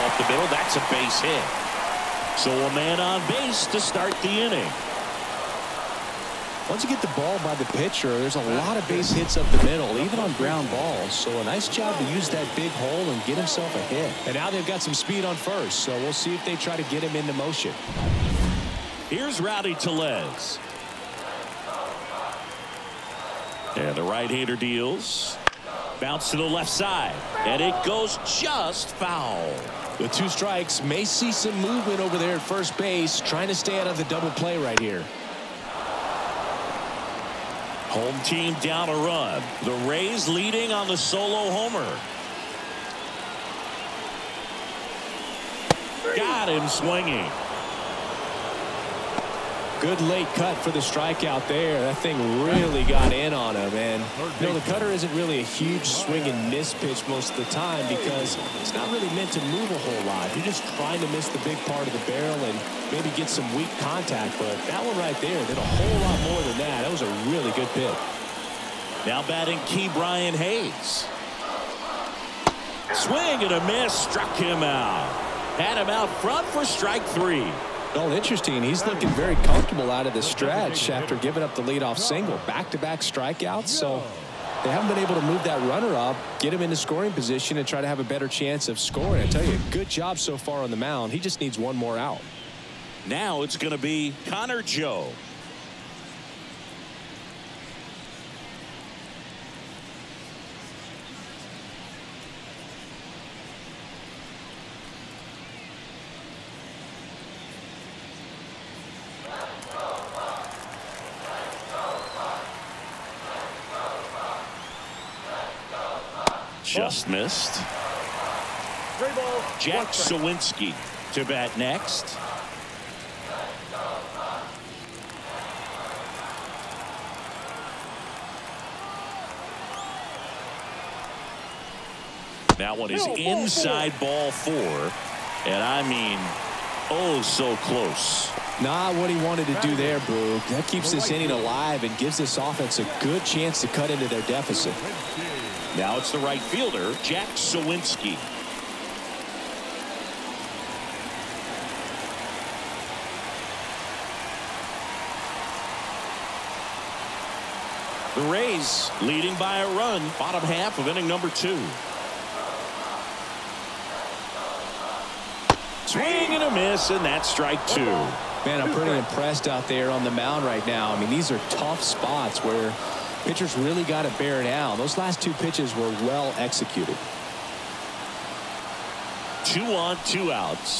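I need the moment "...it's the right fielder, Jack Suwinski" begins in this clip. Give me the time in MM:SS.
02:25.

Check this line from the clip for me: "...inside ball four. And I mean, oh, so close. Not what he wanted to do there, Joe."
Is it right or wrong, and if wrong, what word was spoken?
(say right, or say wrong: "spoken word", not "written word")
wrong: "Boog", not "Joe".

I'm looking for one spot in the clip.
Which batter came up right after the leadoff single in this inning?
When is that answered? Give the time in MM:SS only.
00:19.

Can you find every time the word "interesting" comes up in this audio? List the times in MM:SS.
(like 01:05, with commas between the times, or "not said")
01:18.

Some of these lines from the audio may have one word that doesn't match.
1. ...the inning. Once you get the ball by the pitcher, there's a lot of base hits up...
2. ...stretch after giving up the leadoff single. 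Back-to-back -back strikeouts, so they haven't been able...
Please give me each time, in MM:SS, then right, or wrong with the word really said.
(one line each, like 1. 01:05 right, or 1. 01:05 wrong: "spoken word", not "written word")
1. 00:04 right
2. 01:20 right.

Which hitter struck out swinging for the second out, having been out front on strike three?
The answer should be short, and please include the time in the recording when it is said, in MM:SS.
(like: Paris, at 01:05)
Ke'Bryan Hayes, at 01:09.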